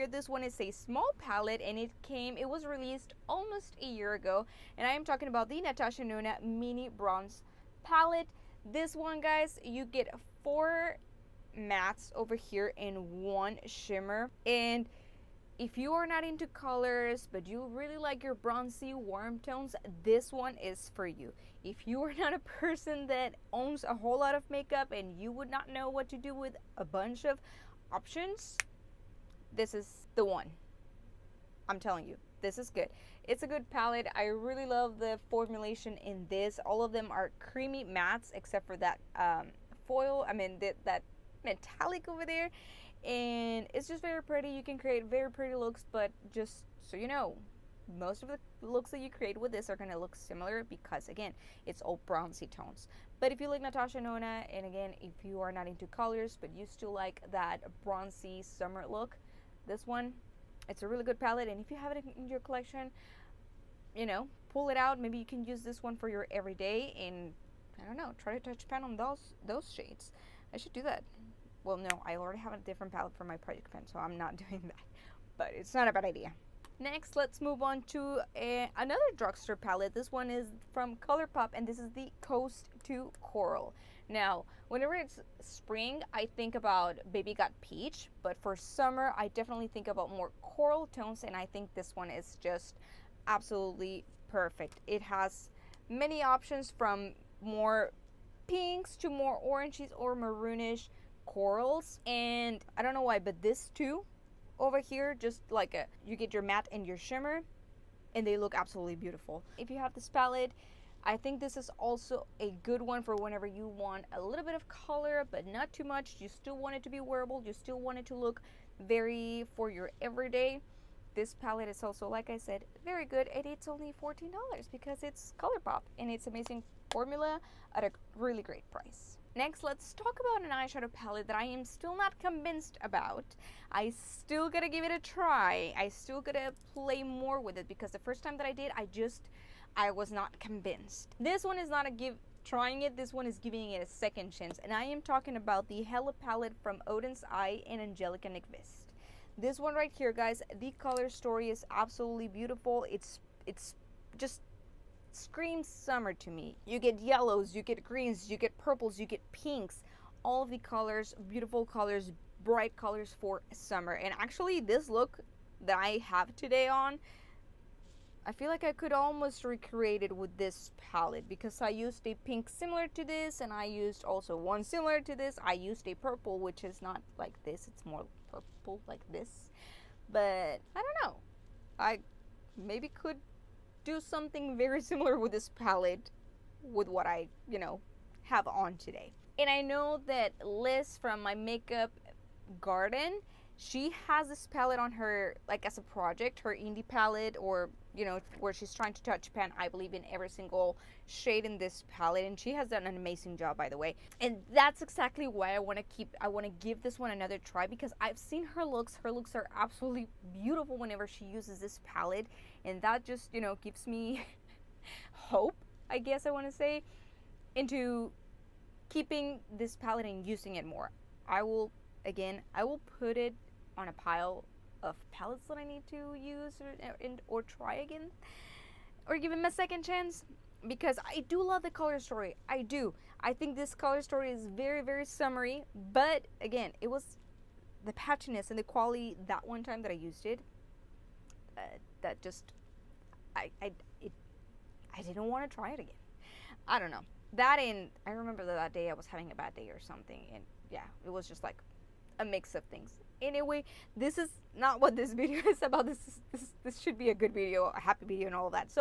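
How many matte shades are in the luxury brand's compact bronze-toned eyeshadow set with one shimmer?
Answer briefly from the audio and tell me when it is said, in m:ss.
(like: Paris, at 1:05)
4, at 0:10.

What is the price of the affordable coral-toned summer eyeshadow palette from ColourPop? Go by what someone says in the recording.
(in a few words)
$14.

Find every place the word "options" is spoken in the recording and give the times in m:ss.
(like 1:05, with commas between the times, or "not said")
0:27, 1:36.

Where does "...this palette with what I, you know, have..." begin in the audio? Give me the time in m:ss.
3:05.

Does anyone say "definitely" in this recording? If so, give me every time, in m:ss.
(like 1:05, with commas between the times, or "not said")
1:29.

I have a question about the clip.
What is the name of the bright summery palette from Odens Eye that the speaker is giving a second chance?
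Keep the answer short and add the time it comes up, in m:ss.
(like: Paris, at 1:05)
Hella, at 2:25.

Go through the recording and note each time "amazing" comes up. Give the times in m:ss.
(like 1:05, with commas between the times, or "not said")
2:06, 3:22.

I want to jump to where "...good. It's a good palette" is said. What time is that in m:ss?
0:32.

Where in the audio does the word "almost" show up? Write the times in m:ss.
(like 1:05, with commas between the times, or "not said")
0:03, 2:48.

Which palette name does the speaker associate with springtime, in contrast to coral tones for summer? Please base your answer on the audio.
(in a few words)
Baby Got Peach.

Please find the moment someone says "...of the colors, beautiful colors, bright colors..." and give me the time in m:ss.
2:40.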